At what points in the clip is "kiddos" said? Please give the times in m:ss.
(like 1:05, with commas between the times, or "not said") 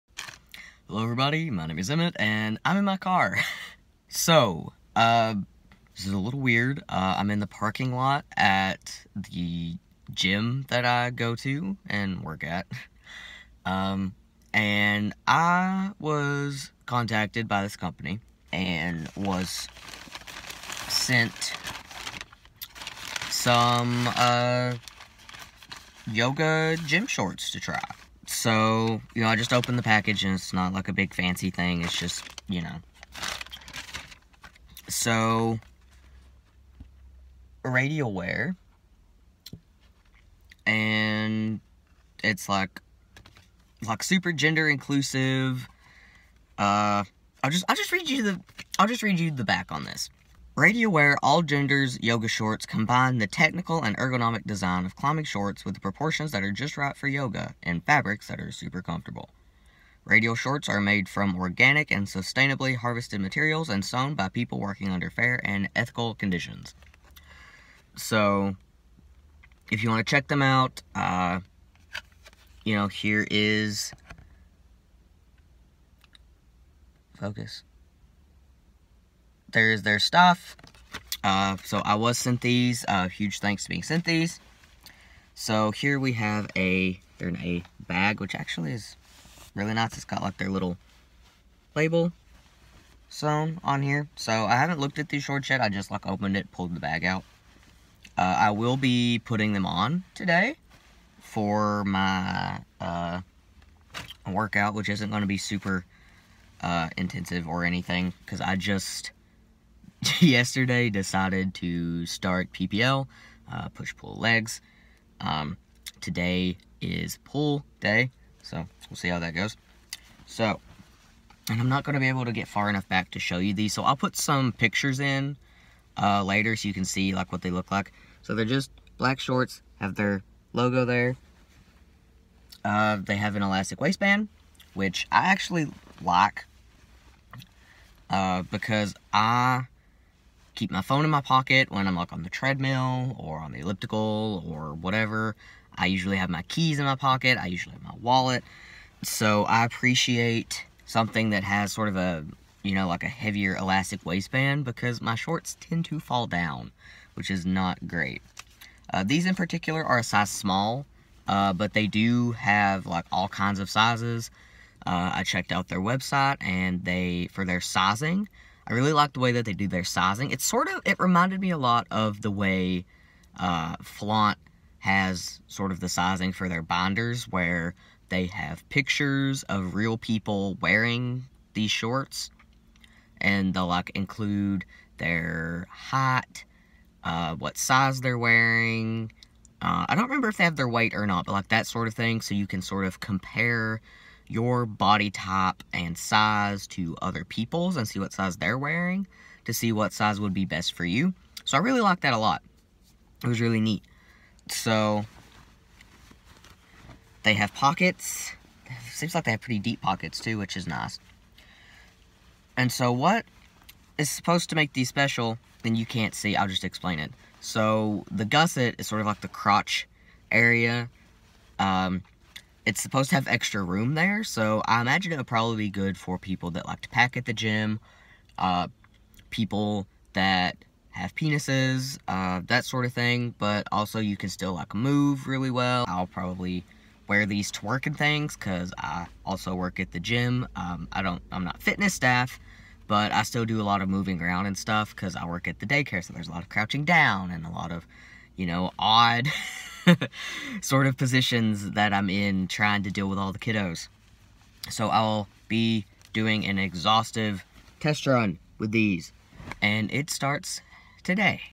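4:13.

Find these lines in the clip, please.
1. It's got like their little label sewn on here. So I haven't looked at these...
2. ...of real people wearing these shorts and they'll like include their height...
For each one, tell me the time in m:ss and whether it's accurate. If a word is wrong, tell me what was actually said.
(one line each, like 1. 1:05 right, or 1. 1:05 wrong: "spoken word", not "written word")
1. 1:29 right
2. 2:59 right.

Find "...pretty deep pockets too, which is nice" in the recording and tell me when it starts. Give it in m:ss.
3:29.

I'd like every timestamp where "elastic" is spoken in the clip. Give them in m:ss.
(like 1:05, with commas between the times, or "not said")
2:13, 2:33.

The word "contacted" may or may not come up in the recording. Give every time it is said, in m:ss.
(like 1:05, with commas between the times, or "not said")
0:16.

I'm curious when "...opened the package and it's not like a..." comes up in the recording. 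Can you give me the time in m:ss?
0:29.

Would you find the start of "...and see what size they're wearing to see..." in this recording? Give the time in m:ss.
3:17.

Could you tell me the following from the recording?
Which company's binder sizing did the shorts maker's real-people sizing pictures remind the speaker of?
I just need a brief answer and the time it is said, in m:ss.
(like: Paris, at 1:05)
FLAVNT, at 2:53.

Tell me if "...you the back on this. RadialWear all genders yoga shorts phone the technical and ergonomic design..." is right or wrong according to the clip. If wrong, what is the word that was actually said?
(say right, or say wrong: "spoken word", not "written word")
wrong: "combine", not "phone".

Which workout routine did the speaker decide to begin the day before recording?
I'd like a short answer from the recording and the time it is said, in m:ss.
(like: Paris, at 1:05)
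push pull legs, at 1:53.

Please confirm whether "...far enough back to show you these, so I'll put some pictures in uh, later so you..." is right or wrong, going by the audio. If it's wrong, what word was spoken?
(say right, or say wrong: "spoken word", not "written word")
right.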